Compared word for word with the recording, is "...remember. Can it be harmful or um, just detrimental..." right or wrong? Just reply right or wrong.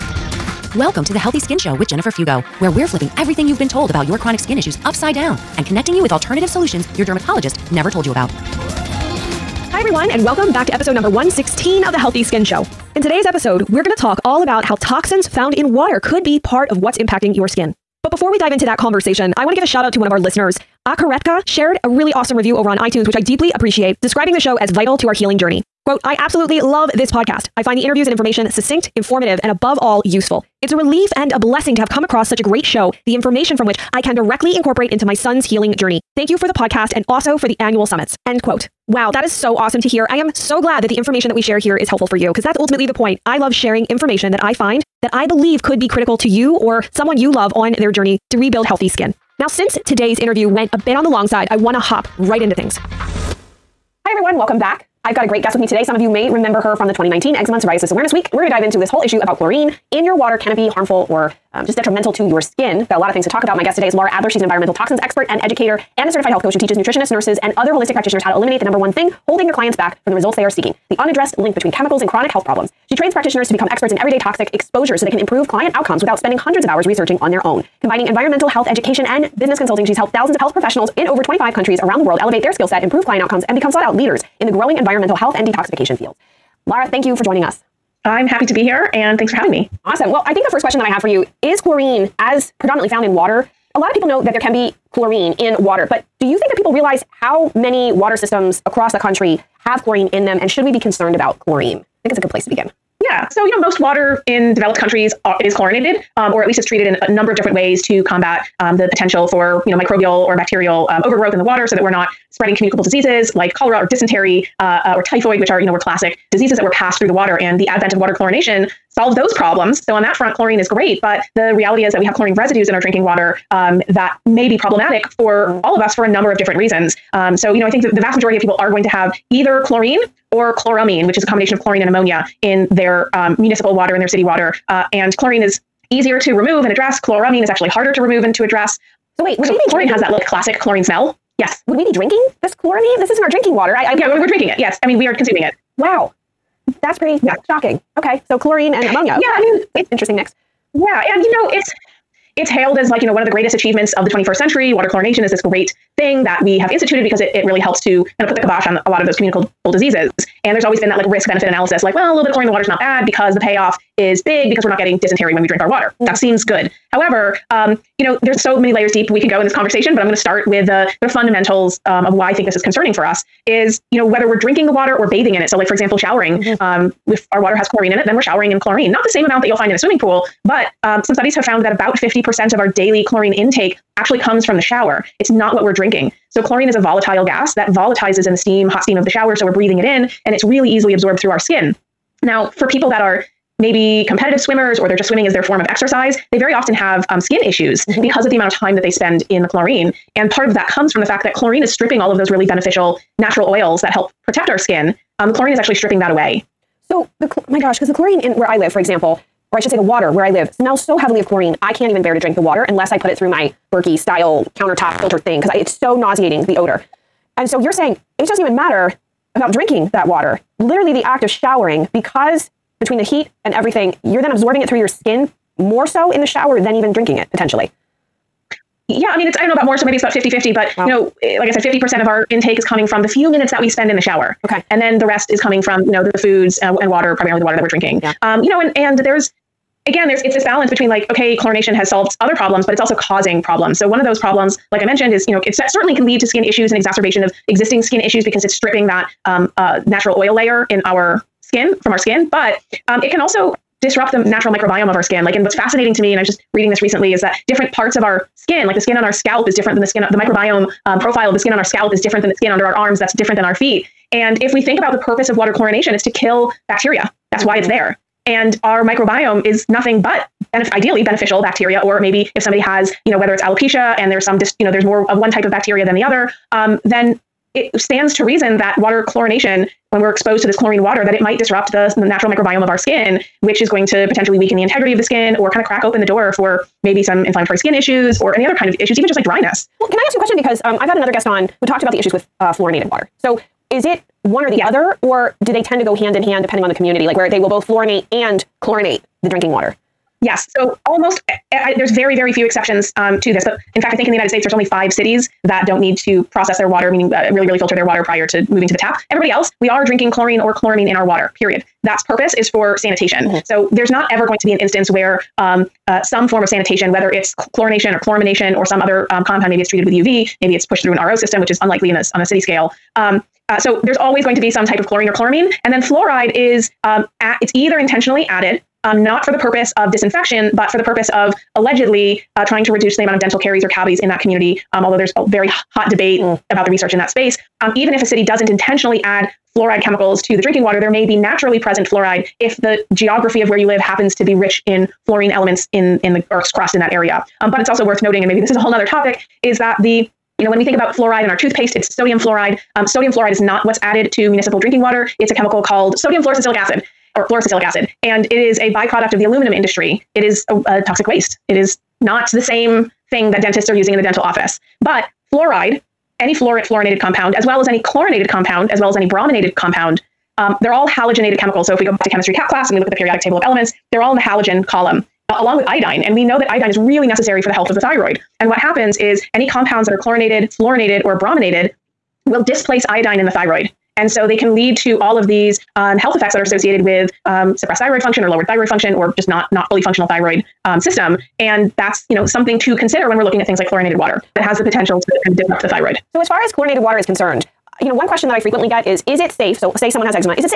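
wrong.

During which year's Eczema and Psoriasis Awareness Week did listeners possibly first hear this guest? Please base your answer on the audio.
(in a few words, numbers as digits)
2019.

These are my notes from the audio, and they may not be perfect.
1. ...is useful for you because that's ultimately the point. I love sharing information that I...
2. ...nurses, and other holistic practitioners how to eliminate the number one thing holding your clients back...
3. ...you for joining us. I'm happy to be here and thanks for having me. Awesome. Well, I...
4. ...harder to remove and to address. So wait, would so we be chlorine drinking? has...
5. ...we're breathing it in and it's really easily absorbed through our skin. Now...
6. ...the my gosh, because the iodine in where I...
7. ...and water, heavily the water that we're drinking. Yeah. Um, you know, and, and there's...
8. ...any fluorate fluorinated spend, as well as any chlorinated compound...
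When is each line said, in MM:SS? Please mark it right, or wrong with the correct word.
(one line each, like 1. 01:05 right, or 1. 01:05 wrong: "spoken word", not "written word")
1. 00:41 wrong: "helpful", not "useful"
2. 01:07 right
3. 01:27 right
4. 02:17 right
5. 03:09 right
6. 03:27 wrong: "chlorine", not "iodine"
7. 03:56 wrong: "primarily", not "heavily"
8. 06:06 wrong: "compound", not "spend".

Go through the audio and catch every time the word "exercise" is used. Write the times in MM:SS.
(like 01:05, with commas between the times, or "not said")
03:15.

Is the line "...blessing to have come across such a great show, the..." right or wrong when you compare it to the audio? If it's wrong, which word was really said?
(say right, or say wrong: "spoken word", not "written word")
right.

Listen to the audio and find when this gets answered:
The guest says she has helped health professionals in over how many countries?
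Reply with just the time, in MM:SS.
01:21.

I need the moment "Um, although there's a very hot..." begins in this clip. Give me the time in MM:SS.
05:34.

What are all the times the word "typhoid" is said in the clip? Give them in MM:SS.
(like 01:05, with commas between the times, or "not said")
01:55.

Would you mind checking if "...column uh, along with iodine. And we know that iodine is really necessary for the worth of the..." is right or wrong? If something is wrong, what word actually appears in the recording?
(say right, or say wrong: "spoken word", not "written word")
wrong: "health", not "worth".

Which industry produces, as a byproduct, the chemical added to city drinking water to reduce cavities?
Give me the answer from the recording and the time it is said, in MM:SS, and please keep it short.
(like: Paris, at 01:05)
aluminum industry, at 05:59.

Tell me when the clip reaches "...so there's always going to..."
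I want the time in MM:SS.
05:23.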